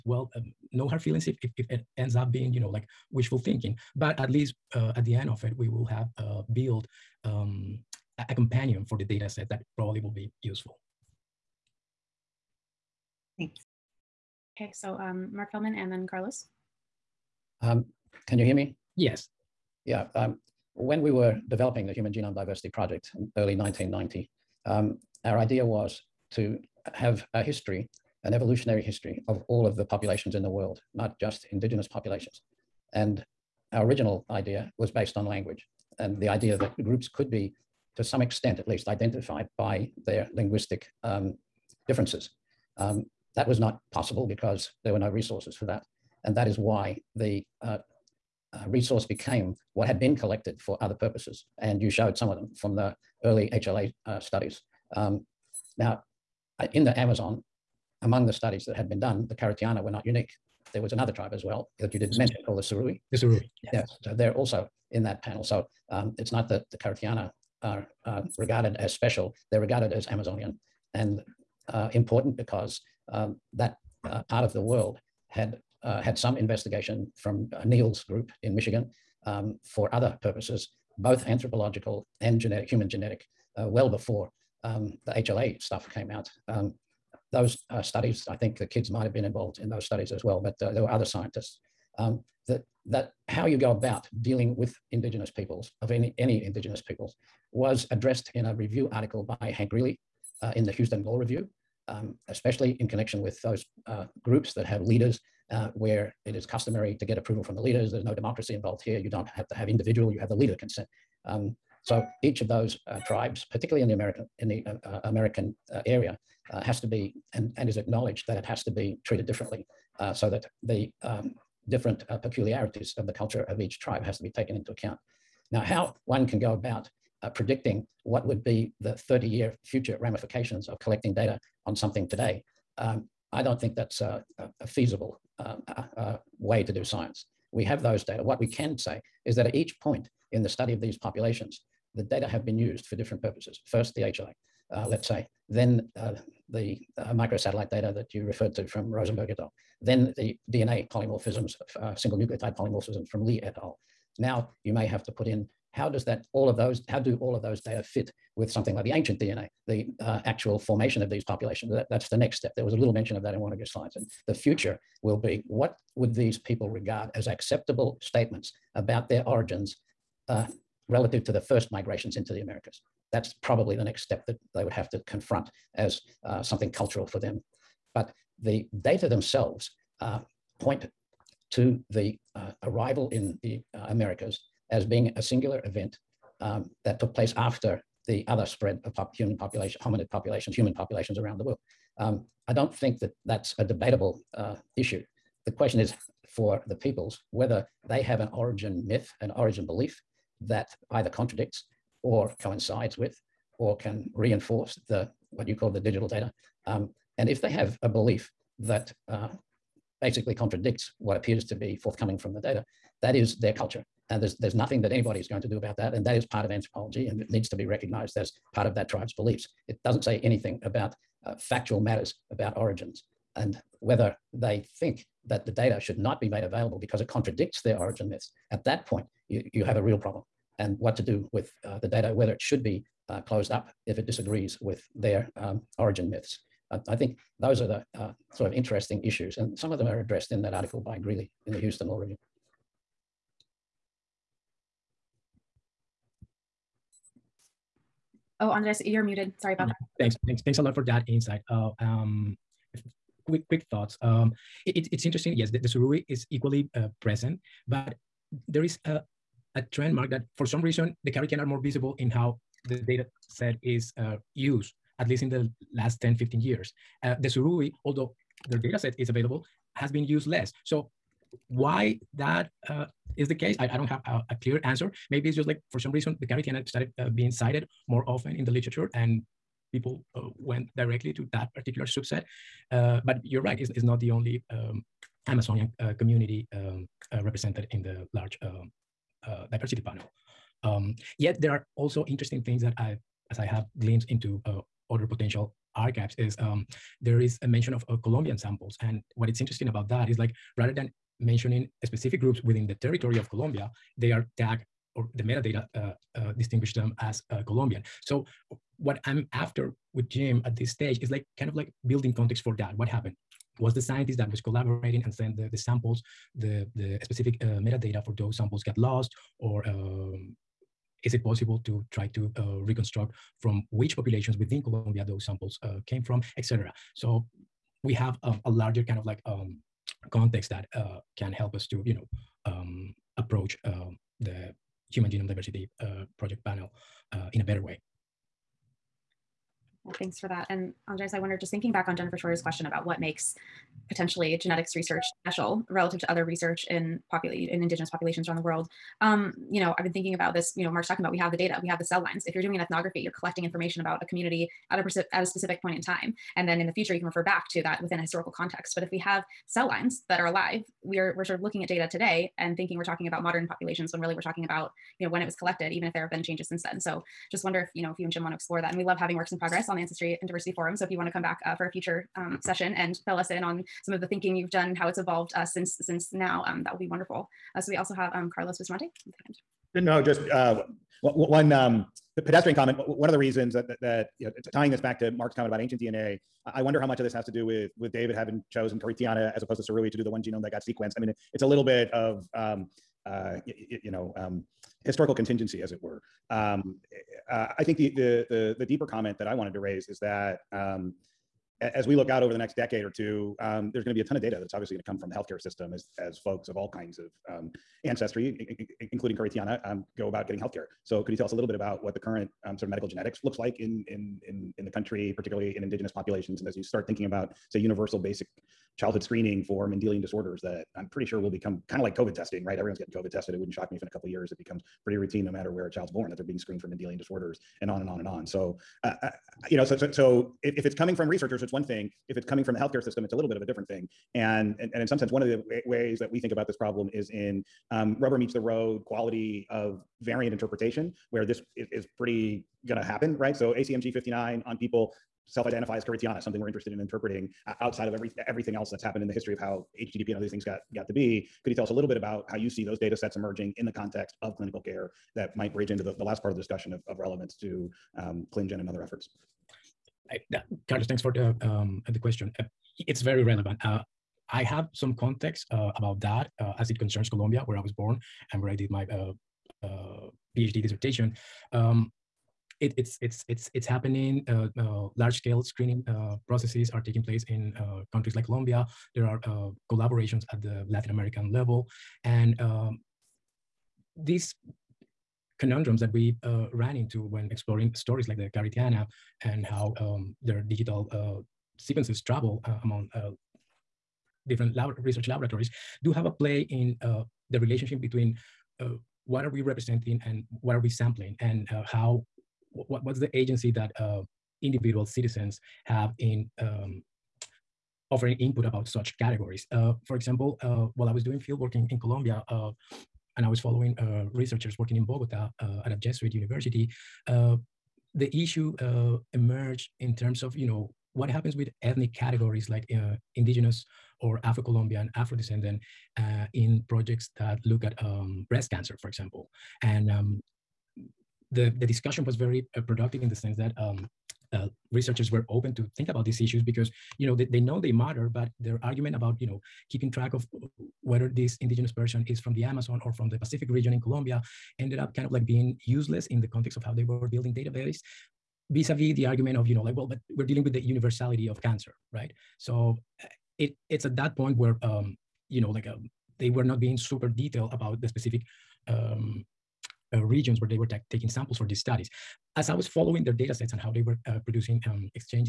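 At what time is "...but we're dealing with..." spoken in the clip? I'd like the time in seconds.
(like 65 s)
549 s.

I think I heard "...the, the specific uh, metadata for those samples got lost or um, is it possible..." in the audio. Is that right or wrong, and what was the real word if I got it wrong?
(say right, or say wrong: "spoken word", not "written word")
right.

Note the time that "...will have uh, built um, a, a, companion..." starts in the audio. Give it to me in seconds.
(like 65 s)
5 s.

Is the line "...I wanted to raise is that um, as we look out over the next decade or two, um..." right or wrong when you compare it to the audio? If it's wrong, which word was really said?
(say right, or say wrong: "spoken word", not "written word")
right.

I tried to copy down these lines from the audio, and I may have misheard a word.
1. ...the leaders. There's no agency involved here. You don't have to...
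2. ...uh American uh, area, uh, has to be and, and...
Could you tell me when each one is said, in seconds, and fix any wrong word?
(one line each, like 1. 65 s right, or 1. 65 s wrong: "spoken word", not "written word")
1. 107 s wrong: "democracy", not "agency"
2. 114 s right.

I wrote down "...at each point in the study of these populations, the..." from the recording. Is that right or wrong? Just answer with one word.
right.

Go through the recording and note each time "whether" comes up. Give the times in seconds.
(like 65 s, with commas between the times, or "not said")
197 s, 223 s, 232 s, 540 s.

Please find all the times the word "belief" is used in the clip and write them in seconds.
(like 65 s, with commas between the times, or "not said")
199 s, 207 s, 219 s.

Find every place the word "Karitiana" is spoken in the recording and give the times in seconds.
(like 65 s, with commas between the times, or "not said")
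59 s, 66 s, 261 s, 276 s, 388 s, 409 s, 445 s, 488 s.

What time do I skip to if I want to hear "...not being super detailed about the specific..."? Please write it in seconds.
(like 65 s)
556 s.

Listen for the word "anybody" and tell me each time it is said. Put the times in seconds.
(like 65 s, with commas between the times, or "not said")
214 s.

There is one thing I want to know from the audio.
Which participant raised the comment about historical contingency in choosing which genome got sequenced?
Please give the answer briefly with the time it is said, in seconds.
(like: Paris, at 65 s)
Carlos Bustamante, at 378 s.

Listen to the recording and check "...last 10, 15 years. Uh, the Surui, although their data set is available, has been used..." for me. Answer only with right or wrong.
right.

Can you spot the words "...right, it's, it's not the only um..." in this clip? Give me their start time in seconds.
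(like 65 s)
283 s.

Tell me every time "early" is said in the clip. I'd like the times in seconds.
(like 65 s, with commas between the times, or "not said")
23 s, 53 s.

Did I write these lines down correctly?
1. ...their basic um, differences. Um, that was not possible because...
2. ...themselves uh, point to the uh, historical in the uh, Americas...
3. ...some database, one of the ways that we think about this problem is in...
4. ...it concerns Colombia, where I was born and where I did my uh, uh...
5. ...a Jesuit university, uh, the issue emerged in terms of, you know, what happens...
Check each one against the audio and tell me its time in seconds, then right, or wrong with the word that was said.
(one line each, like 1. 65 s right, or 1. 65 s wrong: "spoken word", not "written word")
1. 40 s wrong: "linguistic", not "basic"
2. 179 s wrong: "arrival", not "historical"
3. 434 s wrong: "sense", not "database"
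4. 466 s right
5. 515 s right.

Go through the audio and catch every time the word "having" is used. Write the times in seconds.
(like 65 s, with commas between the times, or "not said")
368 s, 388 s.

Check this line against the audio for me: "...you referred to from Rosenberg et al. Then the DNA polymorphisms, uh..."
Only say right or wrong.
right.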